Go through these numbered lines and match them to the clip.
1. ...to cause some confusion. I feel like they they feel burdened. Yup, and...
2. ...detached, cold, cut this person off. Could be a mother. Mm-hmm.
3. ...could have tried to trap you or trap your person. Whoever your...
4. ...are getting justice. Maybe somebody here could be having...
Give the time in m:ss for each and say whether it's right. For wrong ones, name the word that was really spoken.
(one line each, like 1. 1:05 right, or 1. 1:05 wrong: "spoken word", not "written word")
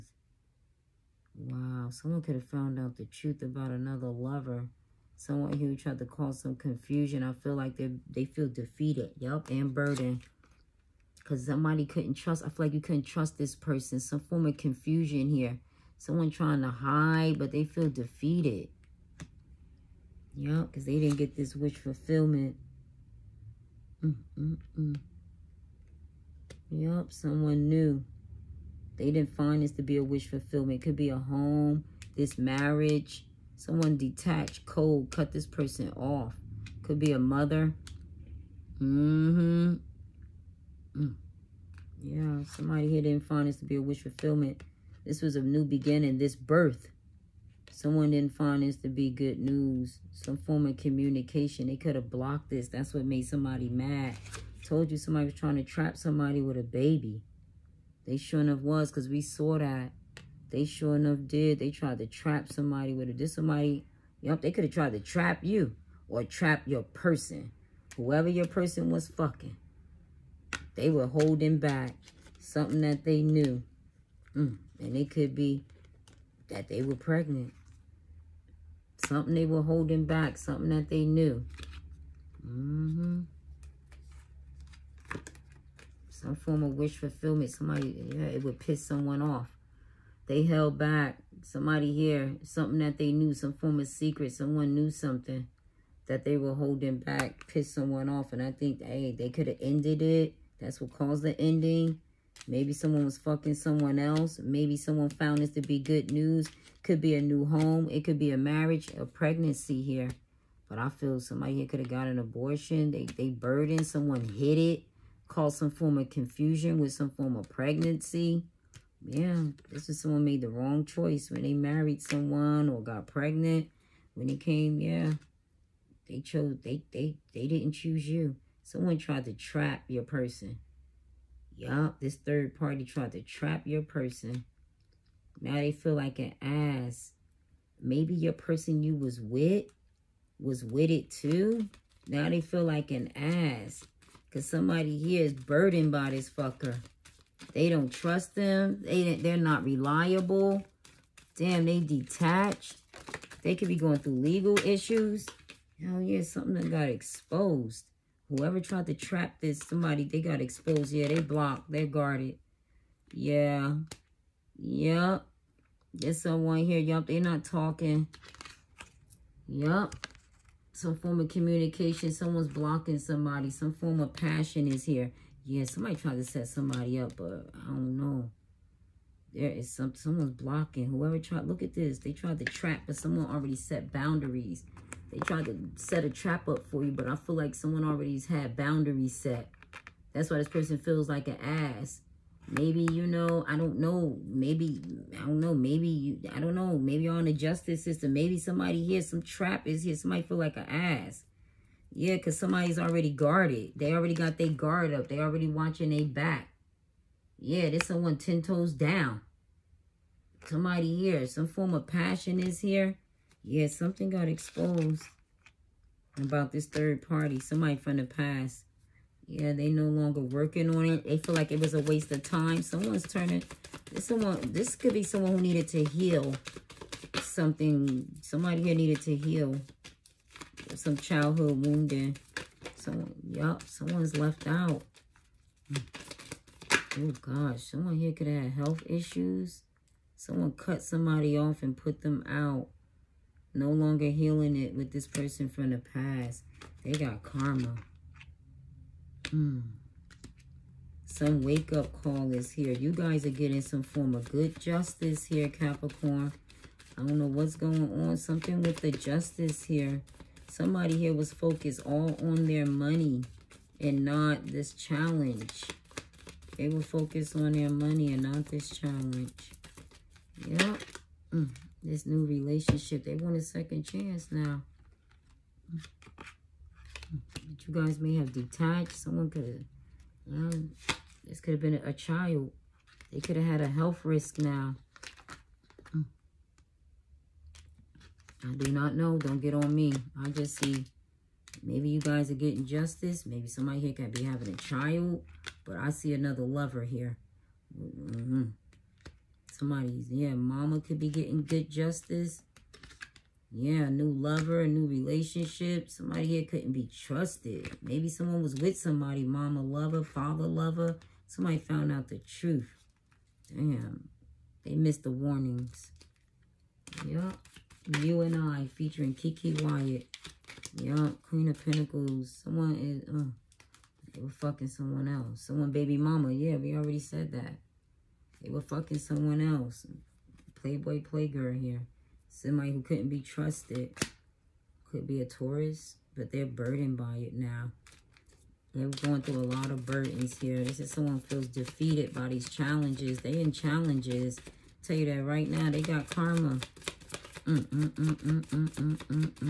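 1. 0:05 wrong: "defeated", not "burdened"
2. 0:33 right
3. 1:04 right
4. 4:52 right.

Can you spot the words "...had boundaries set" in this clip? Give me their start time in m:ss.
3:08.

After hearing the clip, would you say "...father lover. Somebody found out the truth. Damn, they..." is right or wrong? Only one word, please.
right.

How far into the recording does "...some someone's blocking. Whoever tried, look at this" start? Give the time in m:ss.
2:59.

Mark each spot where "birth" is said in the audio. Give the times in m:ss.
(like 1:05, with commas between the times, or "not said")
0:46.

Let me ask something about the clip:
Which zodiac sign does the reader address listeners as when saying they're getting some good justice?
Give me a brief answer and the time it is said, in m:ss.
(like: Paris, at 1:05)
Capricorn, at 4:15.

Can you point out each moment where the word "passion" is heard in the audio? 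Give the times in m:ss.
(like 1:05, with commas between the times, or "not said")
2:54, 3:31.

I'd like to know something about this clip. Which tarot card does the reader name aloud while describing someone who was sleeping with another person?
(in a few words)
Queen of Pentacles.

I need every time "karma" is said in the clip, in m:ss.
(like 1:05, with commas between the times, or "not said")
4:07, 5:46.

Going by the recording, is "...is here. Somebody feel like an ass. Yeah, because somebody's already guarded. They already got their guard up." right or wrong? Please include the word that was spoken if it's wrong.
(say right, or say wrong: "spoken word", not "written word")
right.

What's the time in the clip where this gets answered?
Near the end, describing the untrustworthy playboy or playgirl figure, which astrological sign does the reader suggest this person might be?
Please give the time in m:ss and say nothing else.
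5:35.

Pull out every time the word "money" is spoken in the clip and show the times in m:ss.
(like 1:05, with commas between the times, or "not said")
4:22, 4:27.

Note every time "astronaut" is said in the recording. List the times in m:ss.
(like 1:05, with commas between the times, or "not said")
not said.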